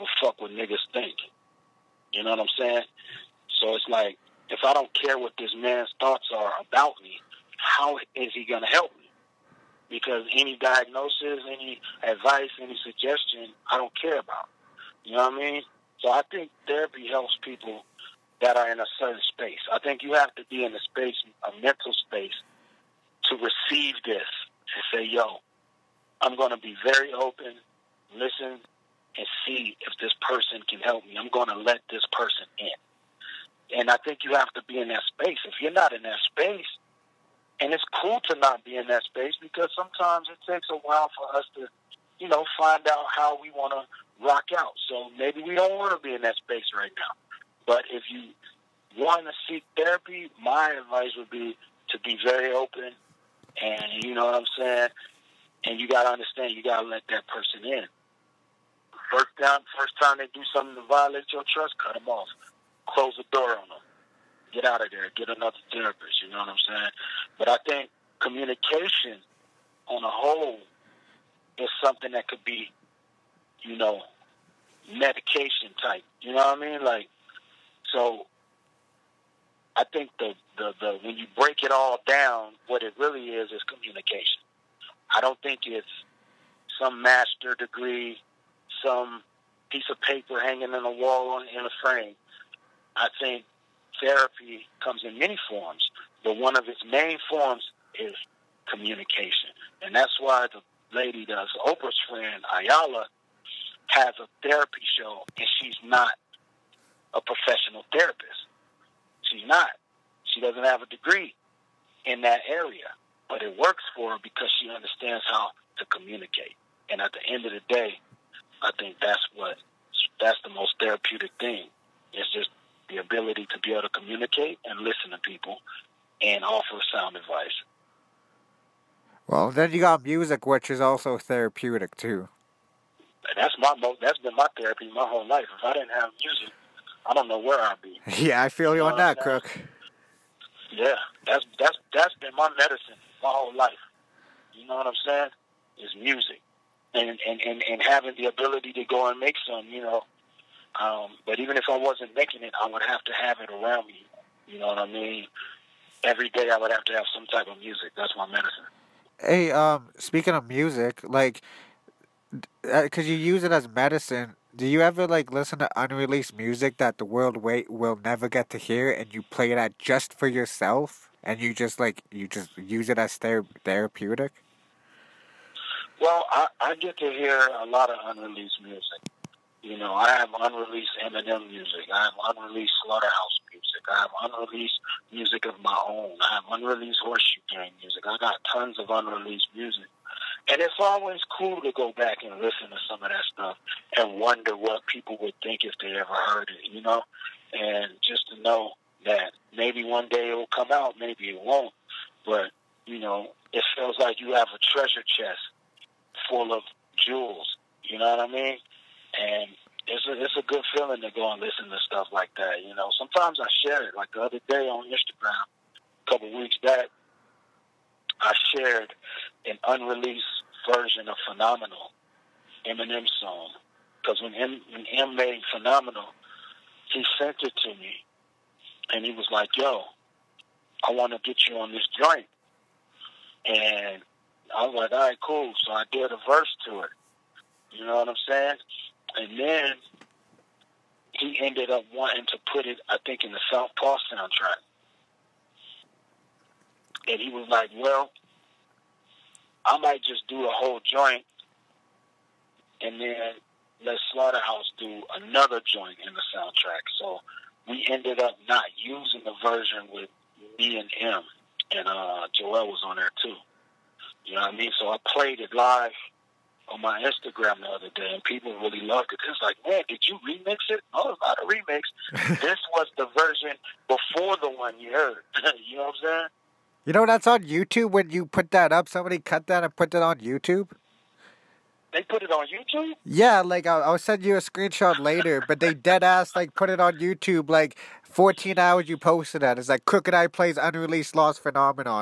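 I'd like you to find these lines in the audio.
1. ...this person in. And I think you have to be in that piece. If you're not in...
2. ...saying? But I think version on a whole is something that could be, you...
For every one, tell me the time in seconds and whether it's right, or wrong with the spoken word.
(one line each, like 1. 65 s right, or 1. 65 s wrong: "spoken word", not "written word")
1. 31 s wrong: "space", not "piece"
2. 66 s wrong: "communication", not "version".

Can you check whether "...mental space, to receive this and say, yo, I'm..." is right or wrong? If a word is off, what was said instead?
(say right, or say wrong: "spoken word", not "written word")
right.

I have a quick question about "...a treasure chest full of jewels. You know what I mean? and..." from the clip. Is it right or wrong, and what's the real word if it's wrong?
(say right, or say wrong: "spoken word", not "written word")
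right.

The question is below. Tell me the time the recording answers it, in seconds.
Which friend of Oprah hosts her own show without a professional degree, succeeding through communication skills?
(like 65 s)
102 s.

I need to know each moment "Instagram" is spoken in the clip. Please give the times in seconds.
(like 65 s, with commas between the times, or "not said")
214 s, 267 s.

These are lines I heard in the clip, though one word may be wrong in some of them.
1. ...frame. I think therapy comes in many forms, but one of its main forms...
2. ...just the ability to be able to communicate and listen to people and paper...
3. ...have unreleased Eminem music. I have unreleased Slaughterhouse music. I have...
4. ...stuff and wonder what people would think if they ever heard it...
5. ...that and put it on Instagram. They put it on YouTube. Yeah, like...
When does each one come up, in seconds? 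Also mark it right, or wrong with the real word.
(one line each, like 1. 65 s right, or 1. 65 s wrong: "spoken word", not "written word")
1. 91 s right
2. 122 s wrong: "offer", not "paper"
3. 180 s right
4. 193 s right
5. 279 s wrong: "YouTube", not "Instagram".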